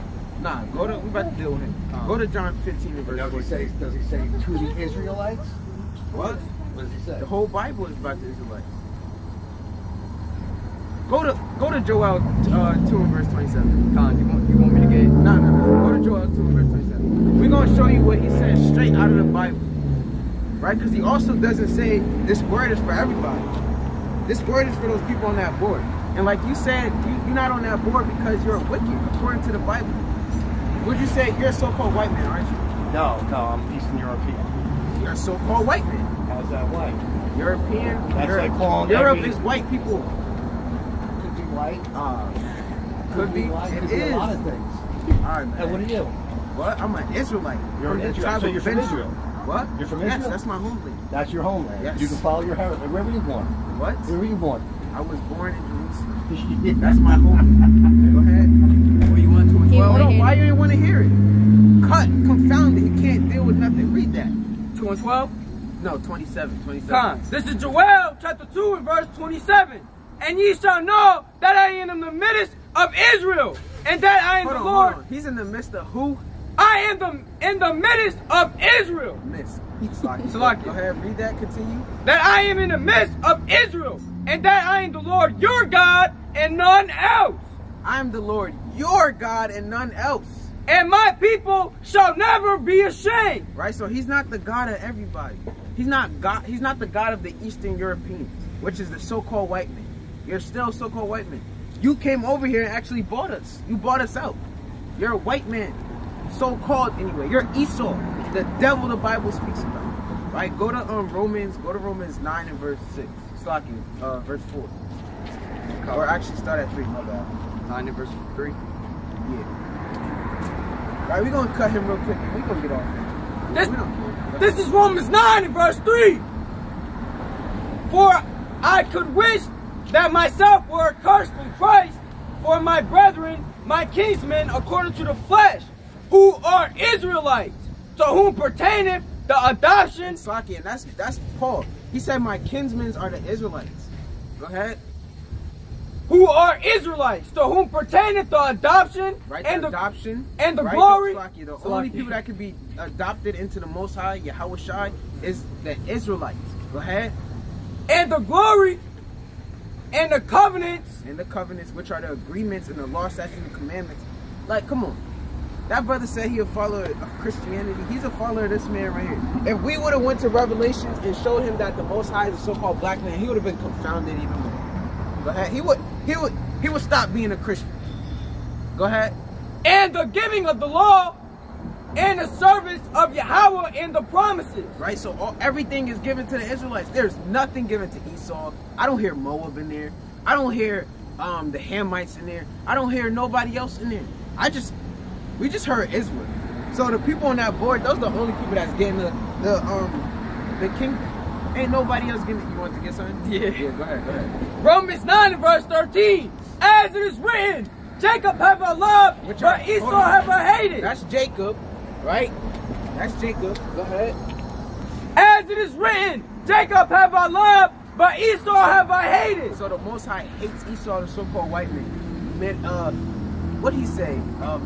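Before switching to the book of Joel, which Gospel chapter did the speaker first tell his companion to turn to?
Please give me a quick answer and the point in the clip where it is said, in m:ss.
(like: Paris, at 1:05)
John 15, at 0:02.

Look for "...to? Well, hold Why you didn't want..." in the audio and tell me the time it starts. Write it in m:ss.
0:59.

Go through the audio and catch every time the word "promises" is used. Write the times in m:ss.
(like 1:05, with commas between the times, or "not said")
3:04.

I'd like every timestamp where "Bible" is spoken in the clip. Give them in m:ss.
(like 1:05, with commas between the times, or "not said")
0:07, 0:19, 0:29, 1:48.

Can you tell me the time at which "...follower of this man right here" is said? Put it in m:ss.
2:48.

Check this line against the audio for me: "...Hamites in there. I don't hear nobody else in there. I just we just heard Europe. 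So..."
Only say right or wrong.
wrong.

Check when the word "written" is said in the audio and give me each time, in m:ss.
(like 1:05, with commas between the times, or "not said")
3:27, 3:35.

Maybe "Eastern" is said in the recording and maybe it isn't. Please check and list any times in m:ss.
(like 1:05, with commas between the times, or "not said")
0:33, 1:37.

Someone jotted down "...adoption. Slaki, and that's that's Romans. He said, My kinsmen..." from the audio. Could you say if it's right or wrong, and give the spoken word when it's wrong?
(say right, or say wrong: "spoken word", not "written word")
wrong: "Paul", not "Romans".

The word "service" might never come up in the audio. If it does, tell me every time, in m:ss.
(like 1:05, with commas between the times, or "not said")
3:02.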